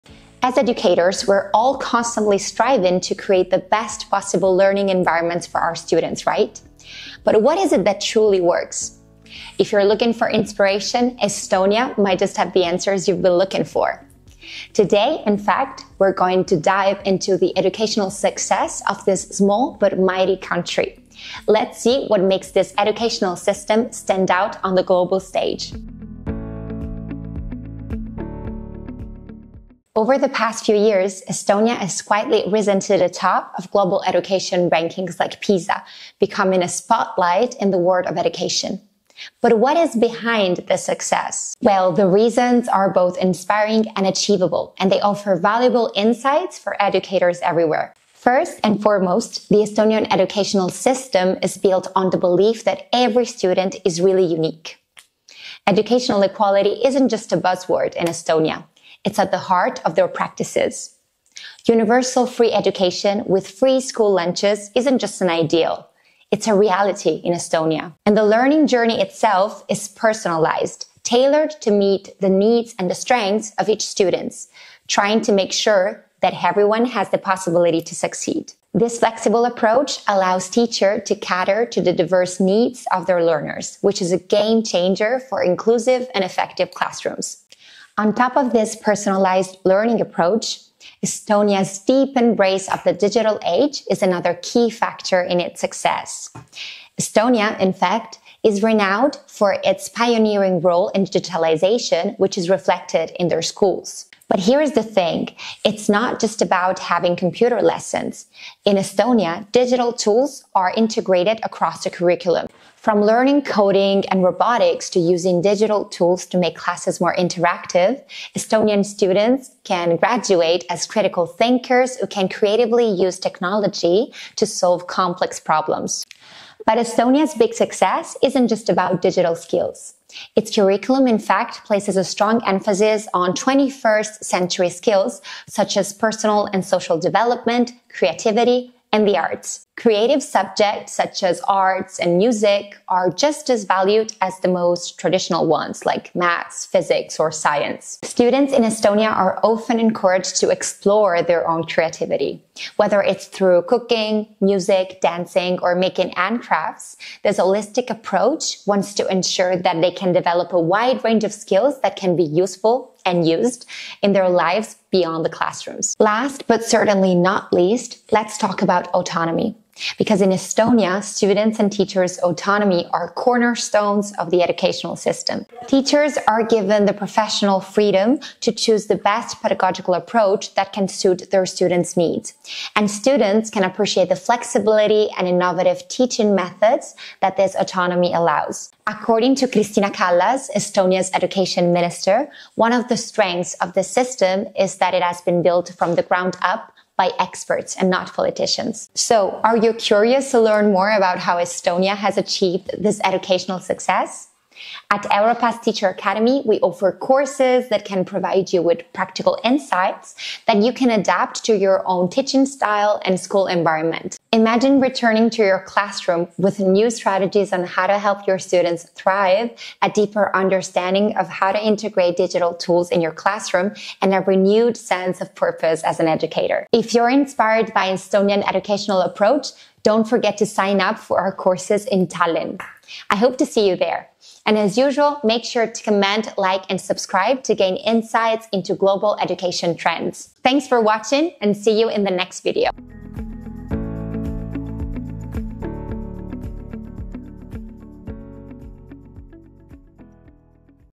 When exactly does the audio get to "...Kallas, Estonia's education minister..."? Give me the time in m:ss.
3:09.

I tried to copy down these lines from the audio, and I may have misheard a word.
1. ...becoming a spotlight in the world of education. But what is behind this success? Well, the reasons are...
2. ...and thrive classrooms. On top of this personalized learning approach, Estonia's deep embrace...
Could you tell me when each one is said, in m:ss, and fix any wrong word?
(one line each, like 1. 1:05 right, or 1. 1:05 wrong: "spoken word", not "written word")
1. 0:36 right
2. 1:26 wrong: "effective", not "thrive".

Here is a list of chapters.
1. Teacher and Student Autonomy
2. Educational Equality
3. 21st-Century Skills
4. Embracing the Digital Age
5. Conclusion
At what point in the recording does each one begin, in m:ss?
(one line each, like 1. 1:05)
1. 2:45
2. 0:29
3. 2:10
4. 1:27
5. 3:18.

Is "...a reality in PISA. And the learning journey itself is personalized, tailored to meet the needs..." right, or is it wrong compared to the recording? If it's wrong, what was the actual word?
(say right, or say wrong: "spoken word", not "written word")
wrong: "Estonia", not "PISA".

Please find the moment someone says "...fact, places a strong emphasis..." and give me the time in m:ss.
2:11.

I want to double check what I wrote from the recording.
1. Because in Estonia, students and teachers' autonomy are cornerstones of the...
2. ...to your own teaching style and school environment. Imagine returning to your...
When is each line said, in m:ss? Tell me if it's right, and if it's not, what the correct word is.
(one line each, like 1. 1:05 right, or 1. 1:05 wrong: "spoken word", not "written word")
1. 2:49 right
2. 3:31 right.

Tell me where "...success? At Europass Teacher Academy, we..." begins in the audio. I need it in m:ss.
3:23.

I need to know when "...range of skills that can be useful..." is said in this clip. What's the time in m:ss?
2:41.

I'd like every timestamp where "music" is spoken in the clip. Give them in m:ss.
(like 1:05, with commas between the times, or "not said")
2:22, 2:34.